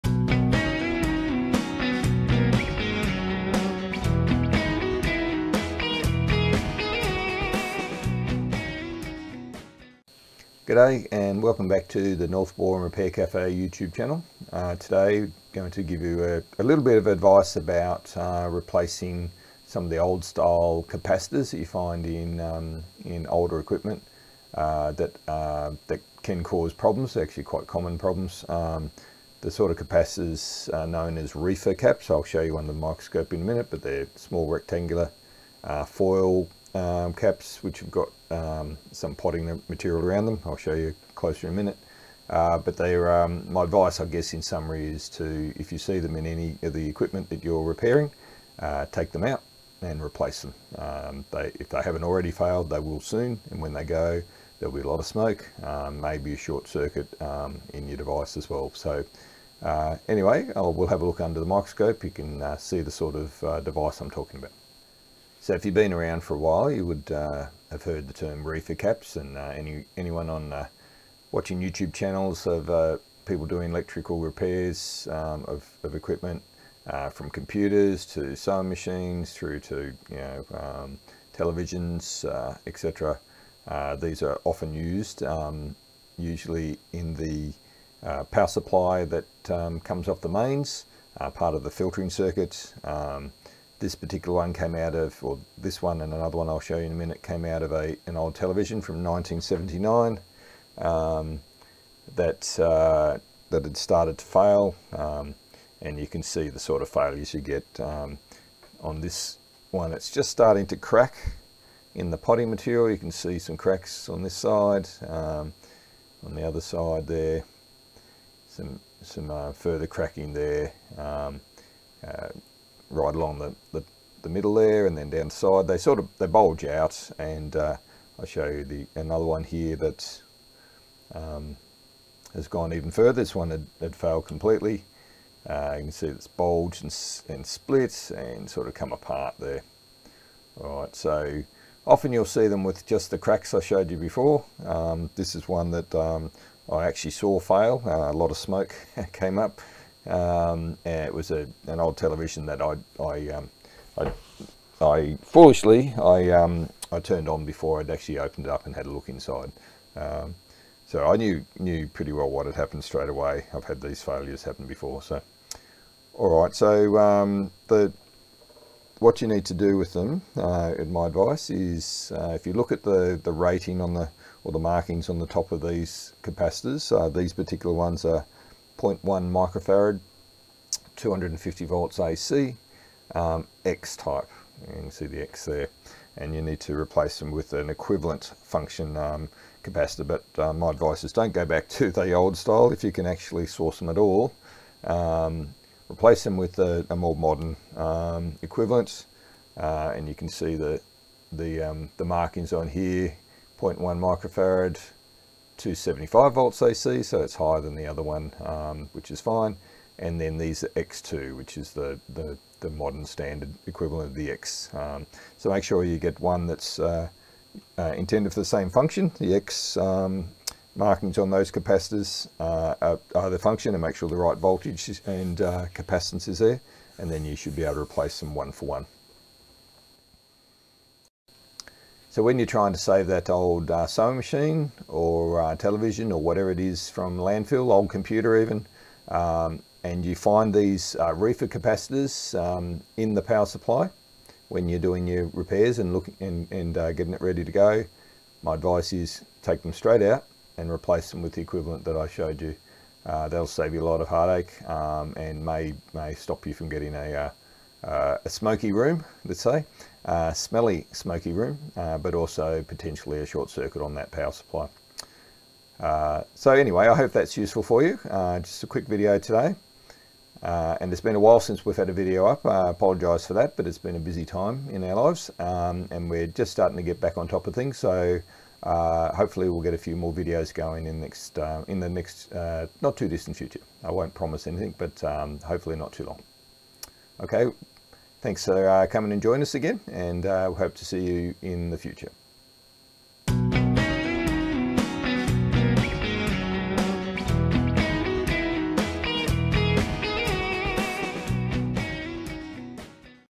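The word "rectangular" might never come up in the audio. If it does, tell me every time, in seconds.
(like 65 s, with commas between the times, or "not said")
34 s.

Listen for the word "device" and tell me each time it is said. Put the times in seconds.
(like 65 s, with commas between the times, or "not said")
57 s, 63 s.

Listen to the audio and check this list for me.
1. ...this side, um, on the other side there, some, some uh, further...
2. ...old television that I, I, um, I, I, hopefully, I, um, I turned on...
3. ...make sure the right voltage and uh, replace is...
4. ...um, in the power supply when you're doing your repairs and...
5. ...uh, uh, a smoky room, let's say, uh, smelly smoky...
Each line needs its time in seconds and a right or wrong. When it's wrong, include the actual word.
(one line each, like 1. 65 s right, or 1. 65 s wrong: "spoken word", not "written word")
1. 114 s right
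2. 151 s wrong: "foolishly", not "hopefully"
3. 223 s wrong: "capacitance", not "replace"
4. 242 s right
5. 257 s right.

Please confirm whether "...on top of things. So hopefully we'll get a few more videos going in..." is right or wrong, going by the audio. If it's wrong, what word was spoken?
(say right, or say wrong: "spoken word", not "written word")
right.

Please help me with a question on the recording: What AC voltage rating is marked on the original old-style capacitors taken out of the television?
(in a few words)
250 volts AC.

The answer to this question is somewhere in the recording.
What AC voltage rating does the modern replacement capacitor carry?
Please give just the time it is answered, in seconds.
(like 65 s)
205 s.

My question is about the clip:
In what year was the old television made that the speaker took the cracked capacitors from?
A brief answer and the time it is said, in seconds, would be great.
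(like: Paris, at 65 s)
1979, at 99 s.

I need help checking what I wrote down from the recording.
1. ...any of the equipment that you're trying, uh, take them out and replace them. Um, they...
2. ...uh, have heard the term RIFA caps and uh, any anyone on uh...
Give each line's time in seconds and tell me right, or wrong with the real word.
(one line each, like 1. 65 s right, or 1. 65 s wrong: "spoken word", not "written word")
1. 46 s wrong: "repairing", not "trying"
2. 67 s right.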